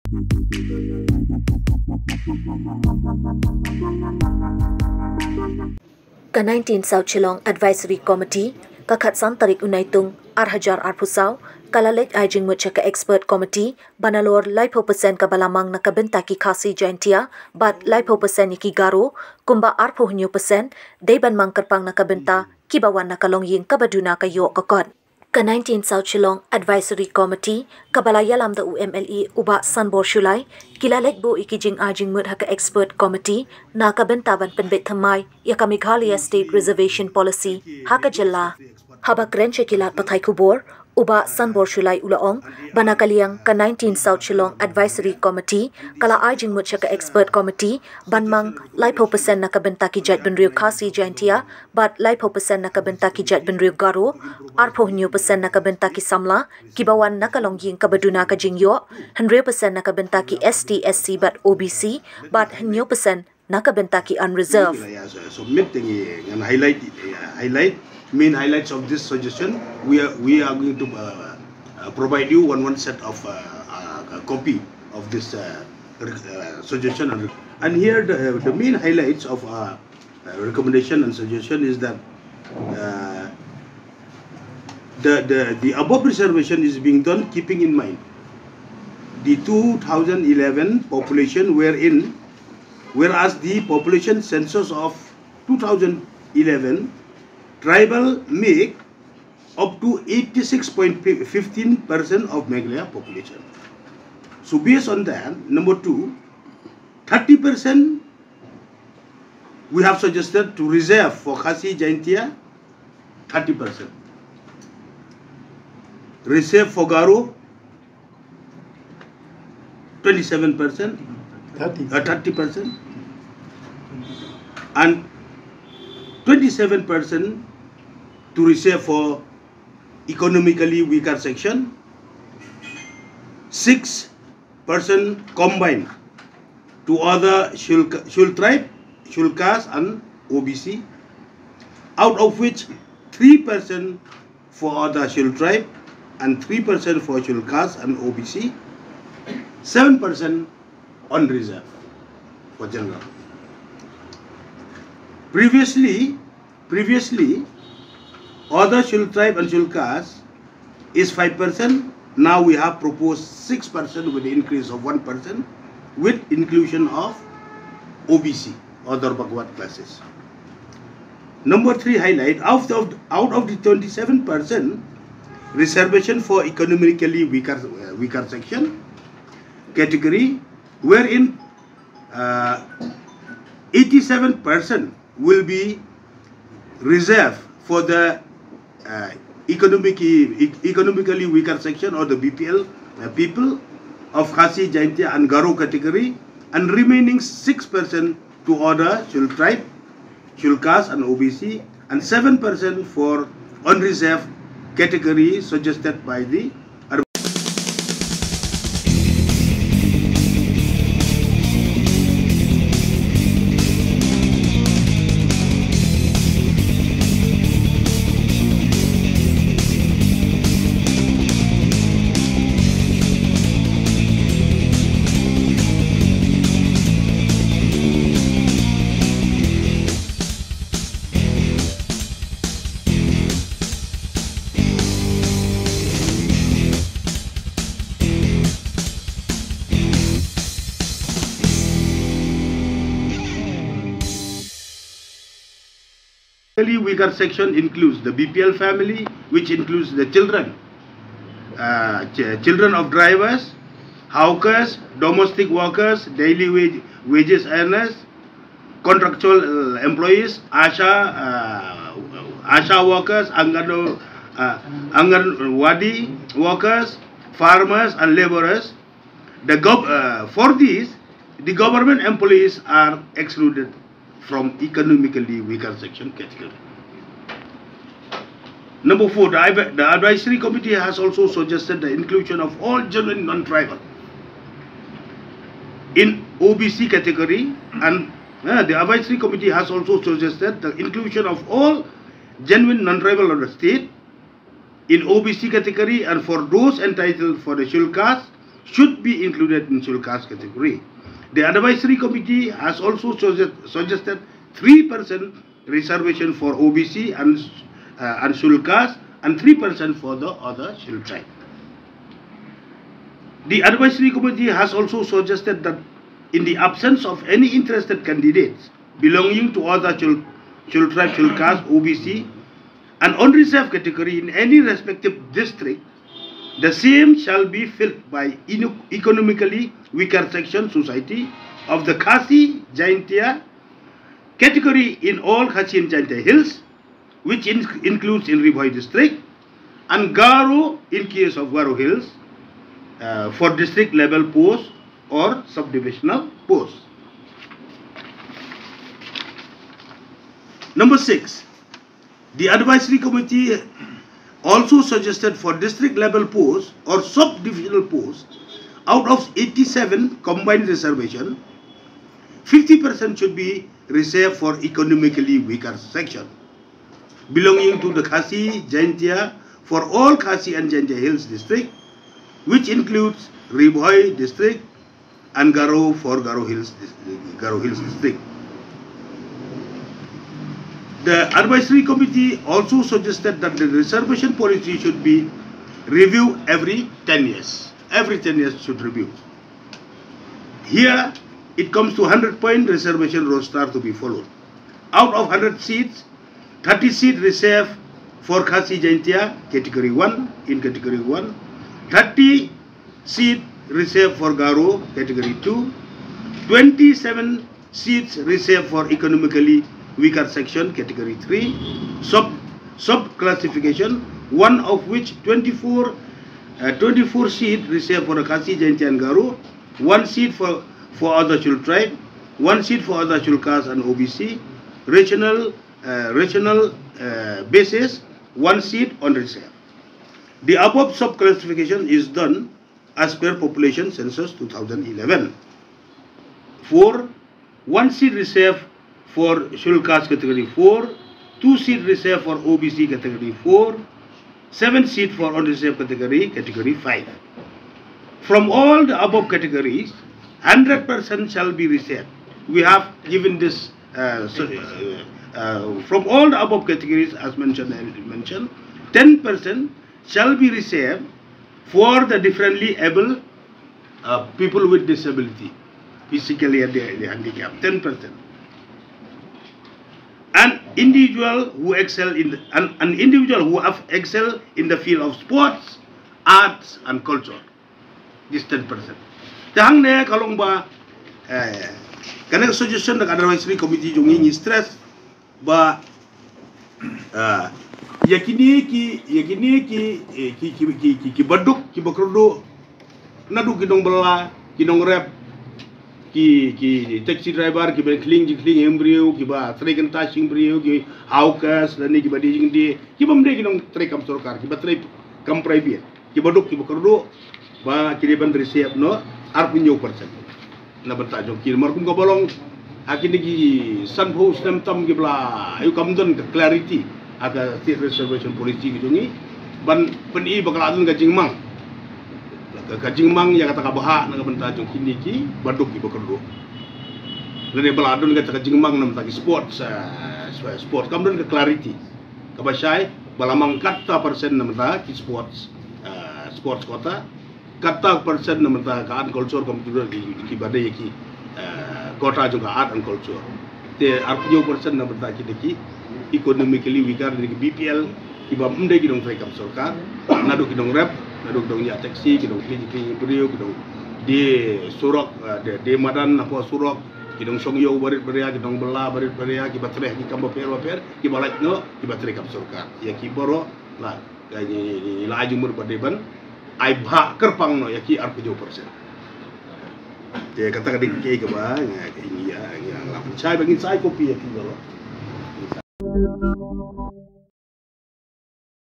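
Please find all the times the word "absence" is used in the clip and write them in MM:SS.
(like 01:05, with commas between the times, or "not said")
05:16.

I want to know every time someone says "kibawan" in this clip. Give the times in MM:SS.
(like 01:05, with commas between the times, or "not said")
00:22, 00:56.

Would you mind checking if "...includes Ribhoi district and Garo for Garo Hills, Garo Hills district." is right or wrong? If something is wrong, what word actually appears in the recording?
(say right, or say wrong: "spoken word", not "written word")
right.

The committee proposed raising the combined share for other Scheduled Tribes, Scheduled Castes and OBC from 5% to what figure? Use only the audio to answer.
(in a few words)
6%.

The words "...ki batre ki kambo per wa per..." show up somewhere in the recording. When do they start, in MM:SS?
09:19.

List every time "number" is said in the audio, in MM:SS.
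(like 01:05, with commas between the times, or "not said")
01:45, 02:51, 04:38, 05:50.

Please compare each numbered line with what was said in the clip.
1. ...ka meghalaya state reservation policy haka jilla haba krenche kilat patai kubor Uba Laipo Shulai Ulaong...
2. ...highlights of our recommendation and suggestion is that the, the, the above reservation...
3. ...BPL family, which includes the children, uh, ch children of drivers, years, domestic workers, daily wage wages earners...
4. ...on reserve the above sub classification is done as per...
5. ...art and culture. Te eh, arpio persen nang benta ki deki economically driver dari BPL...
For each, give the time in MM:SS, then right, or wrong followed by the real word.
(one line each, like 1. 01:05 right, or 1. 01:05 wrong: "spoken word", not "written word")
1. 00:35 wrong: "Sanbor", not "Laipo"
2. 01:18 right
3. 04:08 wrong: "hawkers", not "years"
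4. 07:09 right
5. 09:02 wrong: "weaker", not "driver".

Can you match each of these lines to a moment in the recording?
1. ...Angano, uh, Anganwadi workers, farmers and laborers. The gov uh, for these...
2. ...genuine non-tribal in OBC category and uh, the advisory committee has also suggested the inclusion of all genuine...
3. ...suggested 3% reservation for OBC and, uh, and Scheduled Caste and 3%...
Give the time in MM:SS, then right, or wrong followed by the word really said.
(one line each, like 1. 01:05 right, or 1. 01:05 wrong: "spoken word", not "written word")
1. 04:23 right
2. 04:42 right
3. 05:03 right.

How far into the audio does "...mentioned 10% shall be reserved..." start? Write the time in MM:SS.
07:38.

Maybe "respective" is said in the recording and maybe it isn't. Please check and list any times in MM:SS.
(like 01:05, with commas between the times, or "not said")
05:24.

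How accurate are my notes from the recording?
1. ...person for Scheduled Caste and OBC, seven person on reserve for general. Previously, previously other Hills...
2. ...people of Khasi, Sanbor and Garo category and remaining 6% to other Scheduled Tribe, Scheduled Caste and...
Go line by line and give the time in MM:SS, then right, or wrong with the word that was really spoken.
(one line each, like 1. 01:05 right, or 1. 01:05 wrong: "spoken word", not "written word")
1. 02:26 wrong: "Scheduled", not "Hills"
2. 03:13 wrong: "Jaintia", not "Sanbor".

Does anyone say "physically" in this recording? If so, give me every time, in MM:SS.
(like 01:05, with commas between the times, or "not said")
07:46.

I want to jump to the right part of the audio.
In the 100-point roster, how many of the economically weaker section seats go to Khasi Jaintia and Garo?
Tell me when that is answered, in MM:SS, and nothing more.
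06:56.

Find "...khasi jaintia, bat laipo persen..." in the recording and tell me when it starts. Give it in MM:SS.
00:16.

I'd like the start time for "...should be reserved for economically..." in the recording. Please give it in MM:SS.
06:03.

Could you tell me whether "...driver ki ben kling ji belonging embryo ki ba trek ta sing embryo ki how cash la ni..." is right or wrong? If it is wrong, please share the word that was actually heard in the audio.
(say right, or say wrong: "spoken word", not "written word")
wrong: "kling", not "belonging".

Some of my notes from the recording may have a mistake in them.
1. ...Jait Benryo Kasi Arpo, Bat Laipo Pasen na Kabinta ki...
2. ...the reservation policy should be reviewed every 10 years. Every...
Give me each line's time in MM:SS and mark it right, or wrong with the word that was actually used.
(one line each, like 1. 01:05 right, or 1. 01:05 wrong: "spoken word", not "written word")
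1. 00:50 wrong: "Jaintia", not "Arpo"
2. 06:23 right.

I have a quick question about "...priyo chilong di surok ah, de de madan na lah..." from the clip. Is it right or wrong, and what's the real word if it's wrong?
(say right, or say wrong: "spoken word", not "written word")
wrong: "gidong", not "chilong".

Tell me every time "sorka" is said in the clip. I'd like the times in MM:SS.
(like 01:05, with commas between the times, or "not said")
09:09, 09:22.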